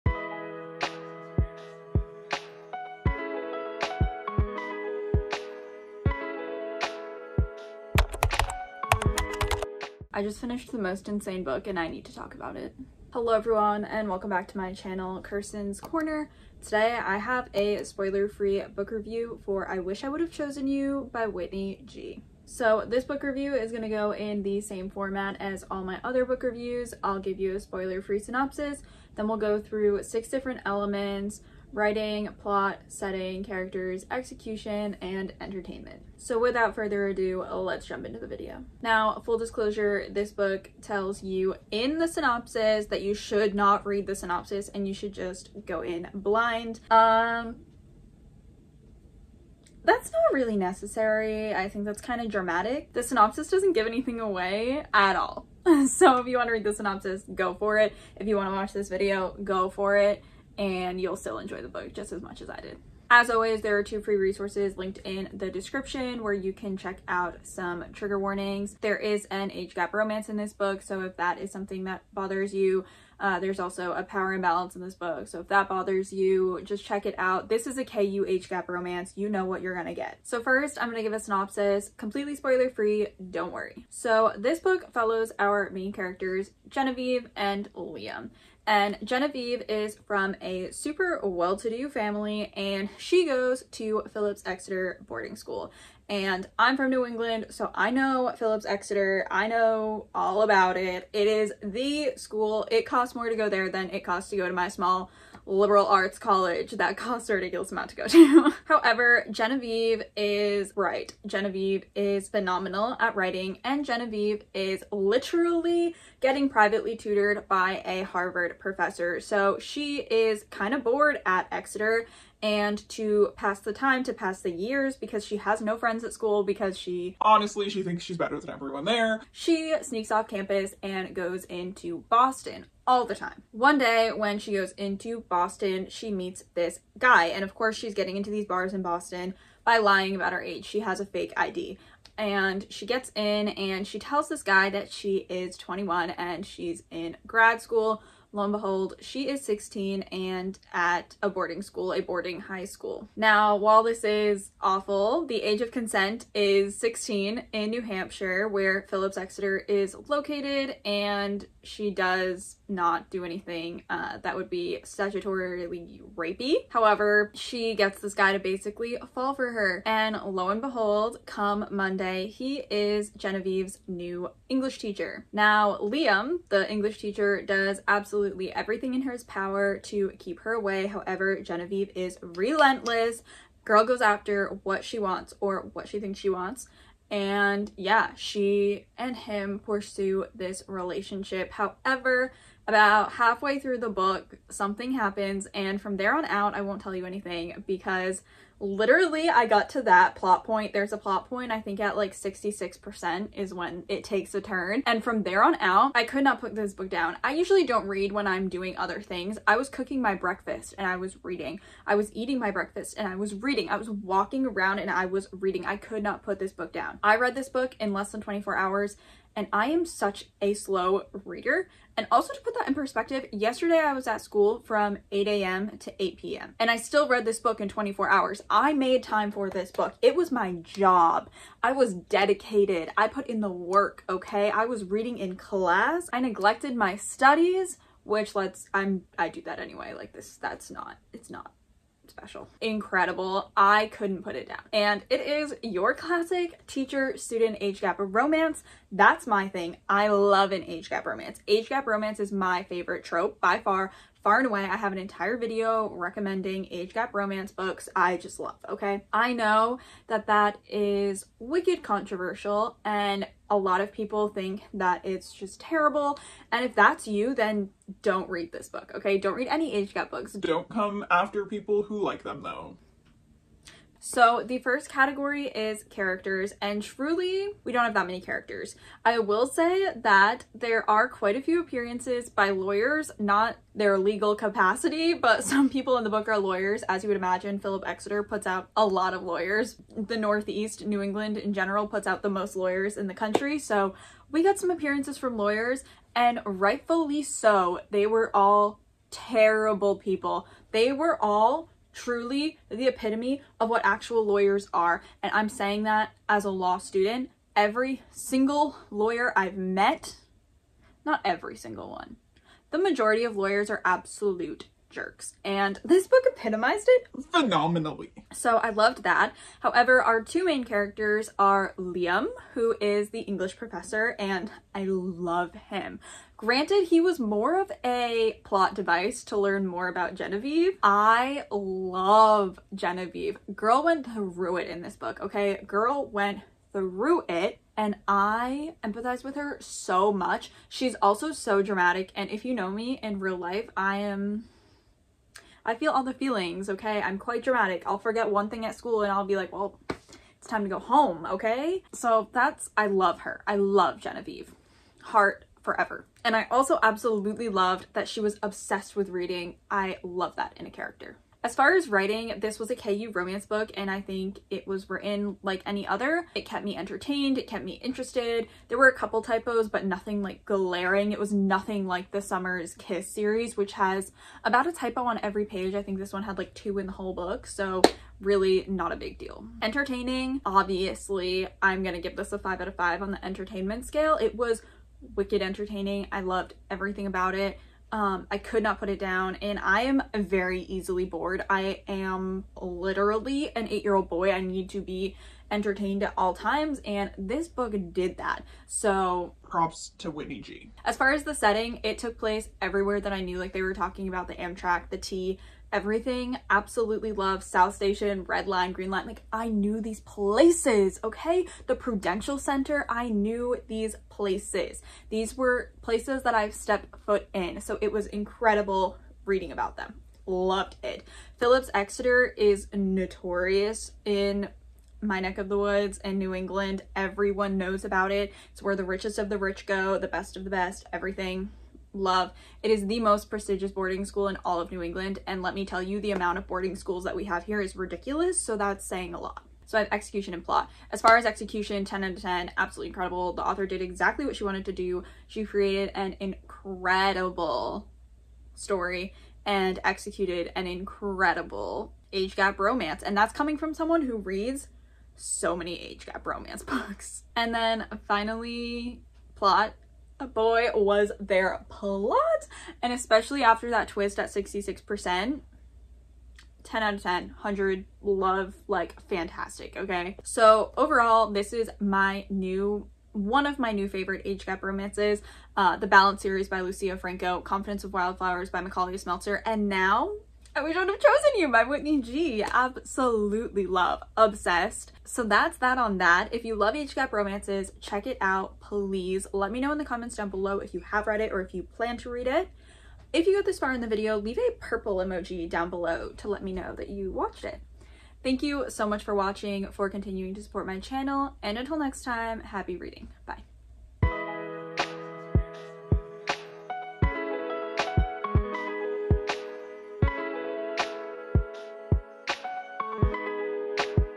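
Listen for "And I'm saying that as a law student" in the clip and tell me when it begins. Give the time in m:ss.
5:05.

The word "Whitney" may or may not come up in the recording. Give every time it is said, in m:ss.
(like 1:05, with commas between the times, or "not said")
0:21, 6:40, 8:01.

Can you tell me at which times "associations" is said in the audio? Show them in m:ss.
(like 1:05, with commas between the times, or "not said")
not said.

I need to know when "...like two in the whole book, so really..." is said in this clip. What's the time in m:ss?
6:16.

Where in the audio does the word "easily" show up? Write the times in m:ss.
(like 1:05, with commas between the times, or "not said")
6:30.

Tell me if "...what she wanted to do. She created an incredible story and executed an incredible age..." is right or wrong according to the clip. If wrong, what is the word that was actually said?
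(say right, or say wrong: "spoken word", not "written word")
right.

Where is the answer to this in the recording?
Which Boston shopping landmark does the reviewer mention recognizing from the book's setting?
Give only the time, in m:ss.
6:51.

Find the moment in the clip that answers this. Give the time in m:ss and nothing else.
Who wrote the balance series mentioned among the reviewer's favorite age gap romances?
7:56.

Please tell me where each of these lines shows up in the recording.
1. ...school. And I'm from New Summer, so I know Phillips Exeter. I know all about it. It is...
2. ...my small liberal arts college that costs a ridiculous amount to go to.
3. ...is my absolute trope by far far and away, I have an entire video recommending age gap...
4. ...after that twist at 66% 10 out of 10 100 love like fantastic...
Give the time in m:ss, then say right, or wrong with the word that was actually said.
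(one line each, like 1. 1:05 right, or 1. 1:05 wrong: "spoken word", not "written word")
1. 1:35 wrong: "England", not "Summer"
2. 1:44 right
3. 4:12 wrong: "favorite", not "absolute"
4. 7:43 right.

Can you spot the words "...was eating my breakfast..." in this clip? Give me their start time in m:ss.
3:31.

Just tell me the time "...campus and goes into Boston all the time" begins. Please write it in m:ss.
2:10.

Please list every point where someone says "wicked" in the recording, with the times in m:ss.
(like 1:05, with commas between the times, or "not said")
4:21, 6:25.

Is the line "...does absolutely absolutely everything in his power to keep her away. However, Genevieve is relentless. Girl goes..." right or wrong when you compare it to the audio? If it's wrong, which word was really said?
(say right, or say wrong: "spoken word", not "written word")
right.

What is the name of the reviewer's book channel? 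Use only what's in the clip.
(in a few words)
Kirsten's Korner.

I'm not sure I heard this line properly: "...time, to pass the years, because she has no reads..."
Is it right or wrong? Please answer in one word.
wrong.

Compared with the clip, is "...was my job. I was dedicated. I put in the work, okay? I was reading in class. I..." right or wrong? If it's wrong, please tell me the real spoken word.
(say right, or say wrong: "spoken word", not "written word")
right.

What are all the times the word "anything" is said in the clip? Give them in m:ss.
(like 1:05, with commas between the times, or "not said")
0:53, 2:43, 3:17.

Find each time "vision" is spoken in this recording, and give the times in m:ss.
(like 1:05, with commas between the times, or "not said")
not said.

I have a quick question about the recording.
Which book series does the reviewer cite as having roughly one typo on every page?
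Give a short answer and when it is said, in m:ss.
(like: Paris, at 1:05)
Summer's Kiss, at 6:12.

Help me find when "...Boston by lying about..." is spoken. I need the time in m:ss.
2:18.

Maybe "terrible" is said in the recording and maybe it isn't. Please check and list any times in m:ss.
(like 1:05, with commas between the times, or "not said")
4:25, 4:59.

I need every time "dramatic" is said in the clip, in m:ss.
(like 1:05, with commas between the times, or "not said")
0:52, 5:41, 5:47.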